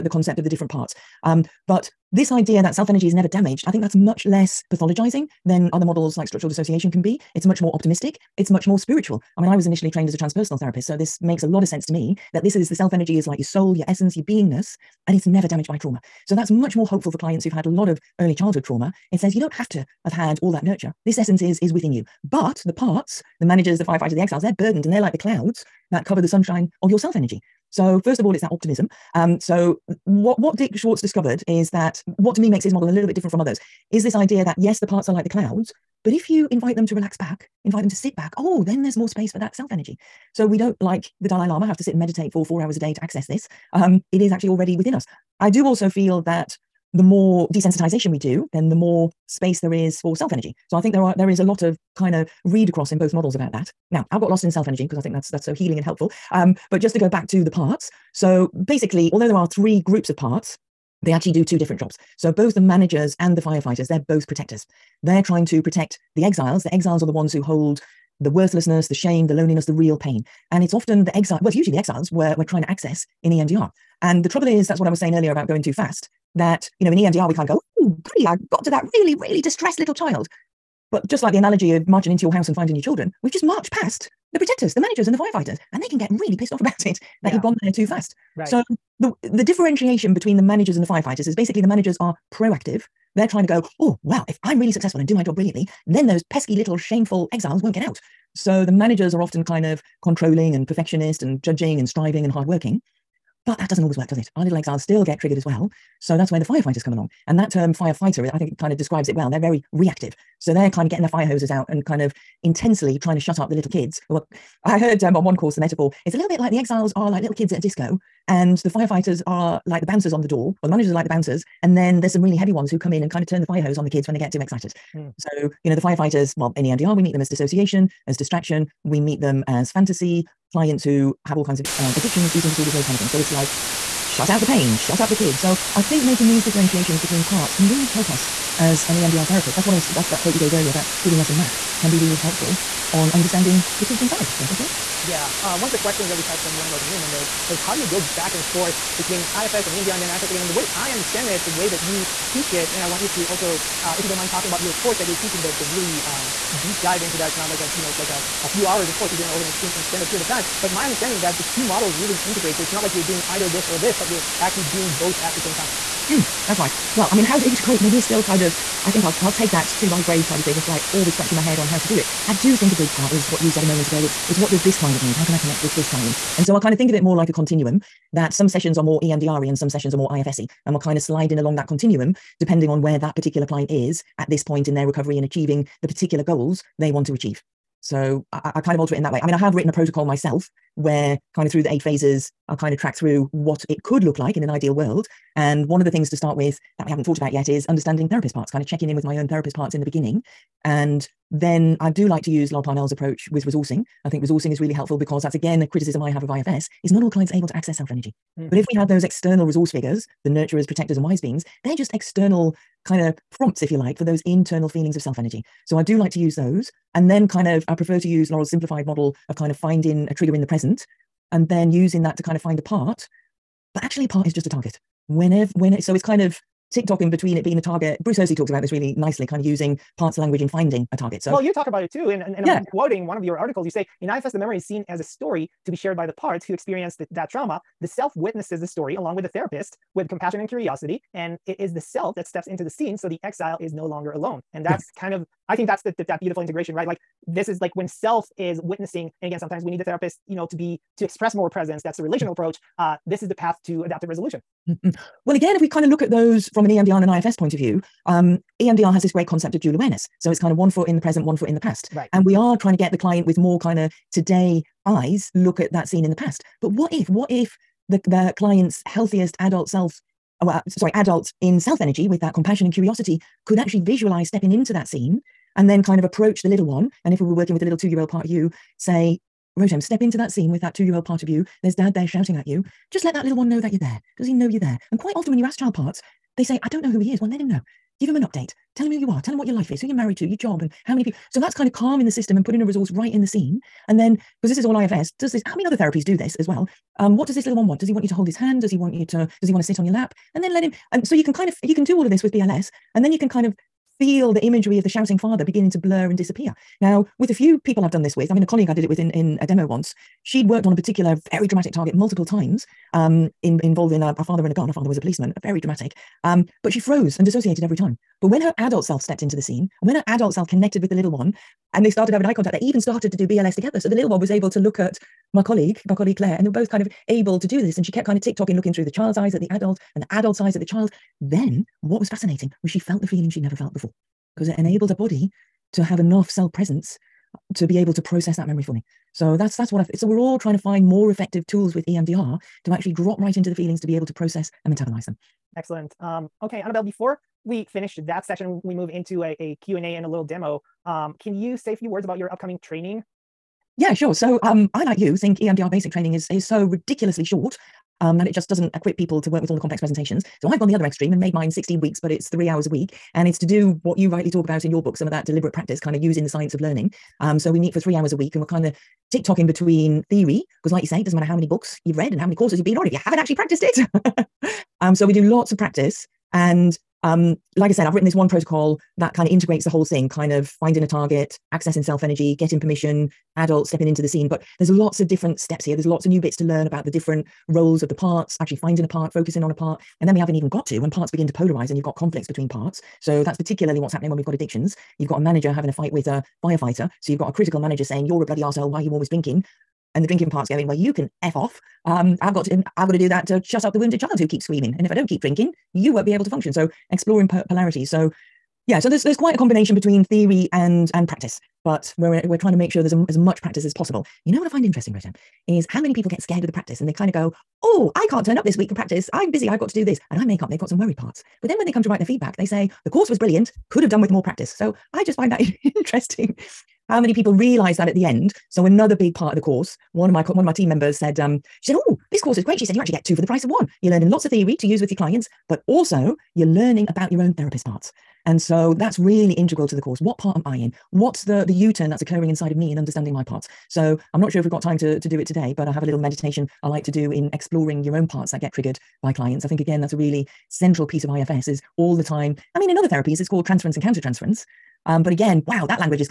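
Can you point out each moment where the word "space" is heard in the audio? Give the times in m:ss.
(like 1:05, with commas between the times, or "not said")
0:39, 0:49.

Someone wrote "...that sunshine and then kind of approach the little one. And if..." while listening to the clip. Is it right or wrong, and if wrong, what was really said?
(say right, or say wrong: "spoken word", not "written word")
wrong: "scene", not "sunshine".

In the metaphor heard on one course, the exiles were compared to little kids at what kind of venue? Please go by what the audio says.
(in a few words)
A disco.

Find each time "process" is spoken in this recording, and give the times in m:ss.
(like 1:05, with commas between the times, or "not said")
5:37, 5:44.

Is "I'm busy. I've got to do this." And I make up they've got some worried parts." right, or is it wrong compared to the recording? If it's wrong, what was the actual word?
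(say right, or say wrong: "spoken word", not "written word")
right.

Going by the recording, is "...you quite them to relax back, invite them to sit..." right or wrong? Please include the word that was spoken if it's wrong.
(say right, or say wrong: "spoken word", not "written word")
wrong: "invite", not "quite".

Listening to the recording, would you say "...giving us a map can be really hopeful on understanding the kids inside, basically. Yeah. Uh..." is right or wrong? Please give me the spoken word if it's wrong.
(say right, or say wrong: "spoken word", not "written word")
wrong: "helpful", not "hopeful".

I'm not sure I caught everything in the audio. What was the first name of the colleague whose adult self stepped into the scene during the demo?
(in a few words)
Claire.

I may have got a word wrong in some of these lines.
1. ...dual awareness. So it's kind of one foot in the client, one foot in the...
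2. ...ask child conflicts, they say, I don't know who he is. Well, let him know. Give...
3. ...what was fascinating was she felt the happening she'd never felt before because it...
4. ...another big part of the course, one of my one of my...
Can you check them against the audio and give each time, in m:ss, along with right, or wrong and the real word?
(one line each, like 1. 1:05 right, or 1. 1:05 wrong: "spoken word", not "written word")
1. 4:19 wrong: "present", not "client"
2. 4:45 wrong: "parts", not "conflicts"
3. 5:31 wrong: "feeling", not "happening"
4. 7:08 right.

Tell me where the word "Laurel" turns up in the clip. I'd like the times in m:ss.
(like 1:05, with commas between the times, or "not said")
3:22, 3:38.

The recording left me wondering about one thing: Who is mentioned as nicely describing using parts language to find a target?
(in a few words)
Bruce Hersey.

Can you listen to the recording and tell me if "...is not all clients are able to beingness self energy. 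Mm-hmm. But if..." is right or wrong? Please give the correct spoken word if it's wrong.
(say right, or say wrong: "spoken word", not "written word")
wrong: "access", not "beingness".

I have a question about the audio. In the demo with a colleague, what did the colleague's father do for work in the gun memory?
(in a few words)
Policeman.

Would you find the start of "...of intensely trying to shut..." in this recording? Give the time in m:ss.
1:51.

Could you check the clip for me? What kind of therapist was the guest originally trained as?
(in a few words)
Transpersonal therapist.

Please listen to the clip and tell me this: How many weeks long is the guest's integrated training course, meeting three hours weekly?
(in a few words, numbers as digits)
16.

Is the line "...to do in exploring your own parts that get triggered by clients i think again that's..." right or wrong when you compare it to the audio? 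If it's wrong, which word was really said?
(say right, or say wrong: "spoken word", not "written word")
right.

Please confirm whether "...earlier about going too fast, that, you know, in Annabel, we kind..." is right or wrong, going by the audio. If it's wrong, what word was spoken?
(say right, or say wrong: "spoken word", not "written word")
wrong: "EMDR", not "Annabel".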